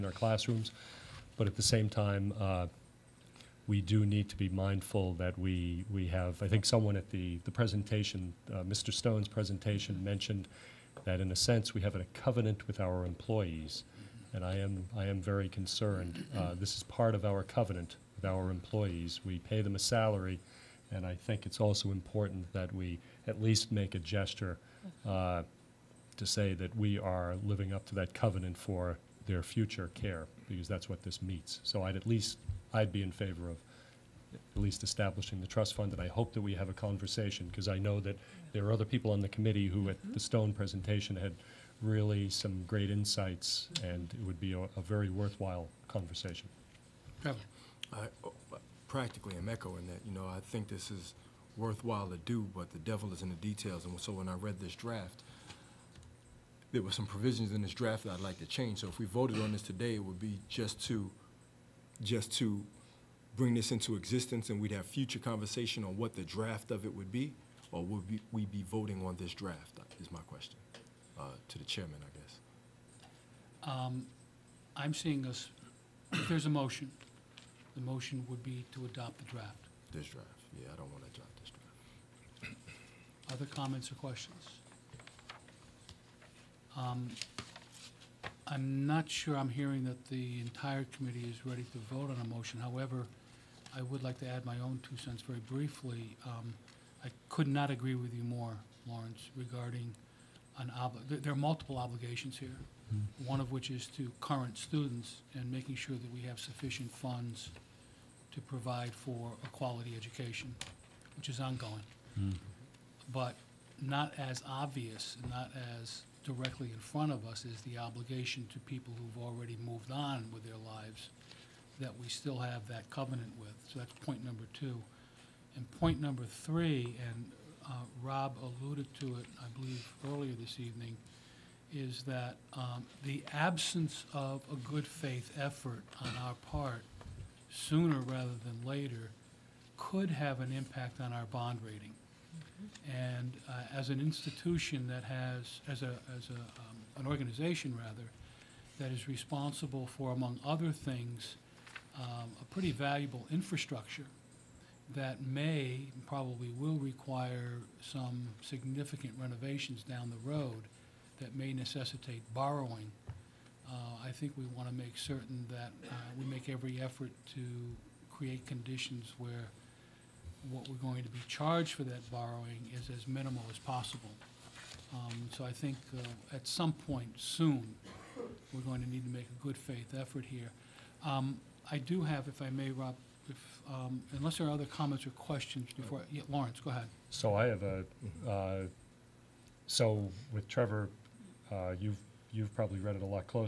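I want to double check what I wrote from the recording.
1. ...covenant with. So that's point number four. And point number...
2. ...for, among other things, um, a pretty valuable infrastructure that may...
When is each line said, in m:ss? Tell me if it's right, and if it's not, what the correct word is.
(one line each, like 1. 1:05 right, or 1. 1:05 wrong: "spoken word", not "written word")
1. 2:02 wrong: "two", not "four"
2. 2:29 right.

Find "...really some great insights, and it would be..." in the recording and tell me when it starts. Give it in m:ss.
0:41.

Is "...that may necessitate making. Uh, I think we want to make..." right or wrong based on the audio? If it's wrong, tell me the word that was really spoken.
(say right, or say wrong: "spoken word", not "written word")
wrong: "borrowing", not "making".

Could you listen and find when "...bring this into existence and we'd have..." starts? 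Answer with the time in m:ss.
1:03.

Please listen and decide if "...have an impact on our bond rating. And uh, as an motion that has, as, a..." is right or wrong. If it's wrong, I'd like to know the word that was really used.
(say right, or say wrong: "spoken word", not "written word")
wrong: "institution", not "motion".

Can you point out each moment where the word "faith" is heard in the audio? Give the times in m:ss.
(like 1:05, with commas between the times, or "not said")
2:14, 2:59.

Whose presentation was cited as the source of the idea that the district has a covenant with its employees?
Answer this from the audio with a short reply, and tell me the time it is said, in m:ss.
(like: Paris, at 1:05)
Mr. Stone, at 0:08.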